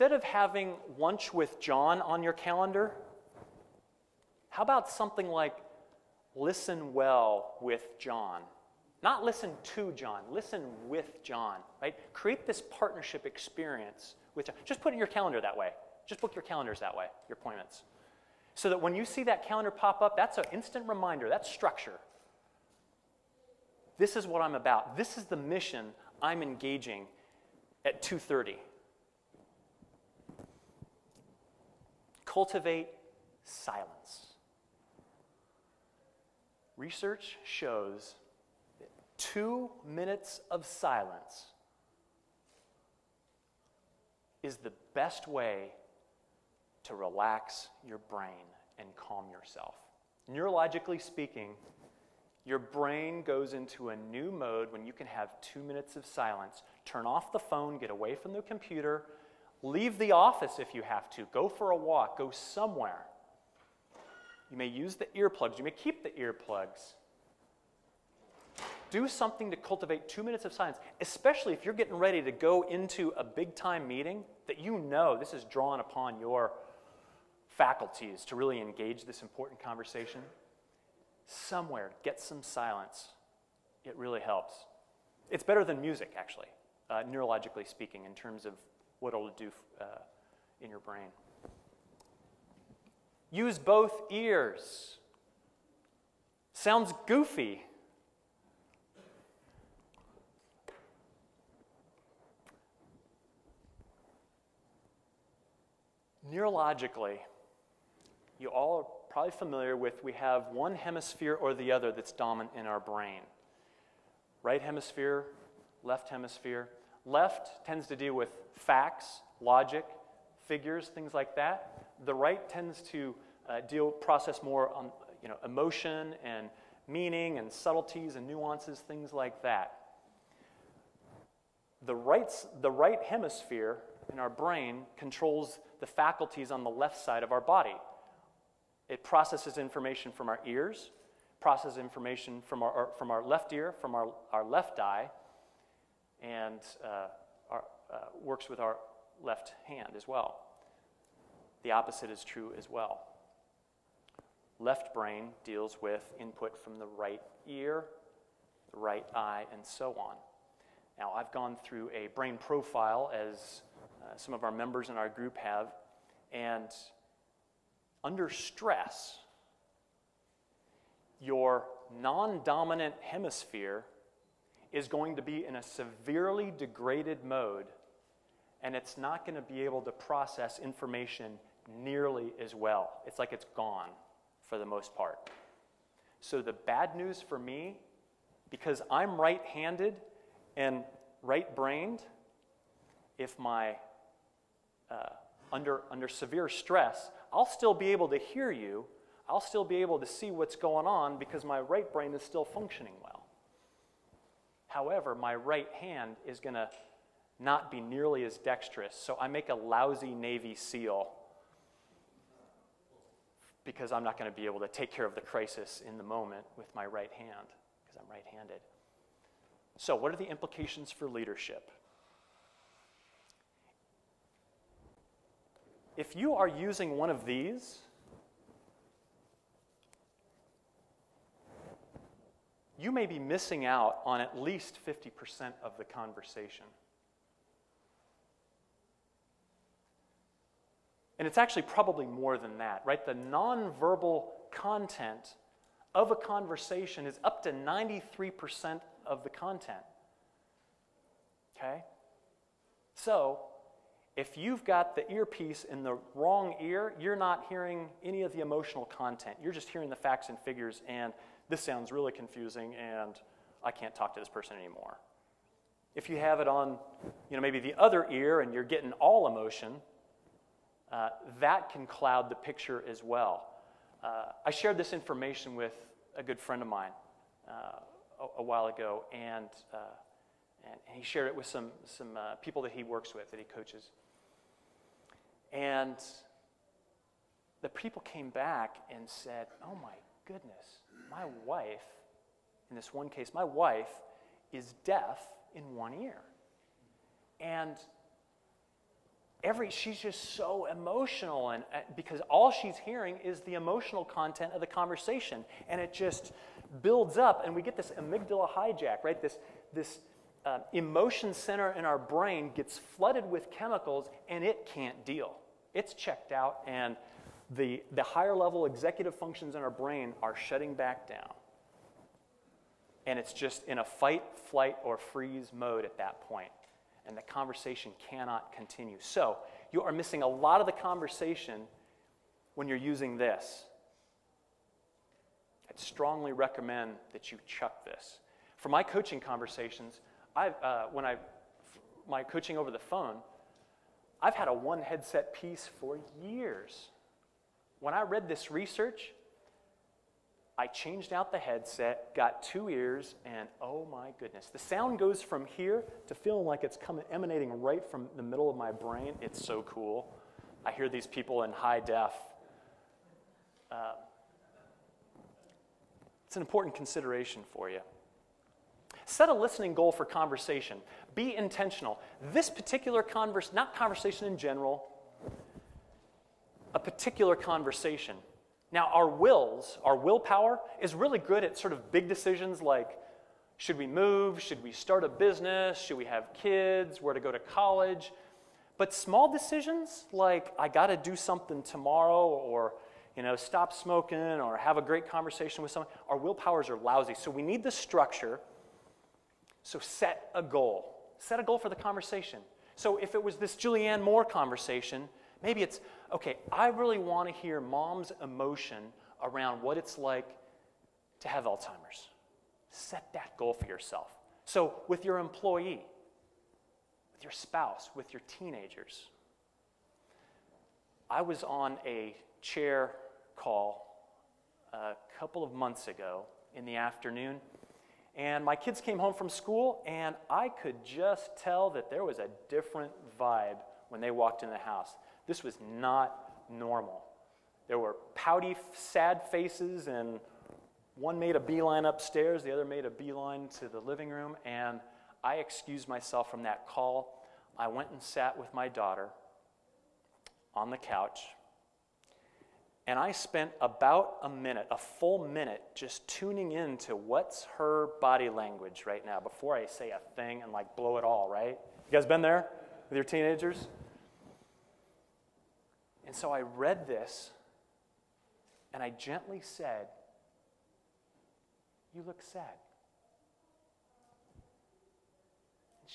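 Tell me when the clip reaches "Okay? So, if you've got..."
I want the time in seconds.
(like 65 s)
251 s.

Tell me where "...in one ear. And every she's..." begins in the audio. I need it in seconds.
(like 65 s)
295 s.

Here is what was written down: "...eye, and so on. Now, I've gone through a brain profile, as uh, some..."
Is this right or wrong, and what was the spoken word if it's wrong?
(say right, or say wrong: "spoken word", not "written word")
right.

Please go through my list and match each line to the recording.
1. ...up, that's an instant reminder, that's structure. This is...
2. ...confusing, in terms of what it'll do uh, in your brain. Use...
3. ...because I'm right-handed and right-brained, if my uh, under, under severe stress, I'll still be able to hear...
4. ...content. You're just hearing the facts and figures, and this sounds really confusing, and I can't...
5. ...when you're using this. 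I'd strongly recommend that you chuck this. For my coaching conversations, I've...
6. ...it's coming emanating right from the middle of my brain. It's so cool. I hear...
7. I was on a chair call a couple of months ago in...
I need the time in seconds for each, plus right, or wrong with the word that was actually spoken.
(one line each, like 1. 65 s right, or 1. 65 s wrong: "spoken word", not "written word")
1. 20 s right
2. 87 s wrong: "speaking", not "confusing"
3. 188 s right
4. 258 s right
5. 332 s right
6. 356 s right
7. 421 s right.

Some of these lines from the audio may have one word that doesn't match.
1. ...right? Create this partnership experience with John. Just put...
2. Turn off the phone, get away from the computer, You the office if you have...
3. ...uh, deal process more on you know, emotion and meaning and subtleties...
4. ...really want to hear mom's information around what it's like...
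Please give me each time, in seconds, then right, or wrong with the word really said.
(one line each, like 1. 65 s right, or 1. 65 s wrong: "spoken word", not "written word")
1. 11 s right
2. 56 s wrong: "Leave", not "You"
3. 123 s right
4. 406 s wrong: "emotion", not "information".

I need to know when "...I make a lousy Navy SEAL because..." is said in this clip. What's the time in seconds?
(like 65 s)
209 s.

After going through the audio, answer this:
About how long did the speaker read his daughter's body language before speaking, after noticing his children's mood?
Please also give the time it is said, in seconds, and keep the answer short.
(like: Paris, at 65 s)
1 minute, at 454 s.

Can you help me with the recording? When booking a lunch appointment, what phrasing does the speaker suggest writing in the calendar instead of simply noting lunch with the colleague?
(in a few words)
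listen well with John.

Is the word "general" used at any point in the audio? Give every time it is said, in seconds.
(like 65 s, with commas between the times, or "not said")
374 s.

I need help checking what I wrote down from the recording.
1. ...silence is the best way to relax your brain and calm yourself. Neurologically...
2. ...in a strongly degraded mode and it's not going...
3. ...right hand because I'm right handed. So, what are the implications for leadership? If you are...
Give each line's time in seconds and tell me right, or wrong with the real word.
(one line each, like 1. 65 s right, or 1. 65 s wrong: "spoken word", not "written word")
1. 40 s right
2. 175 s wrong: "severely", not "strongly"
3. 216 s right.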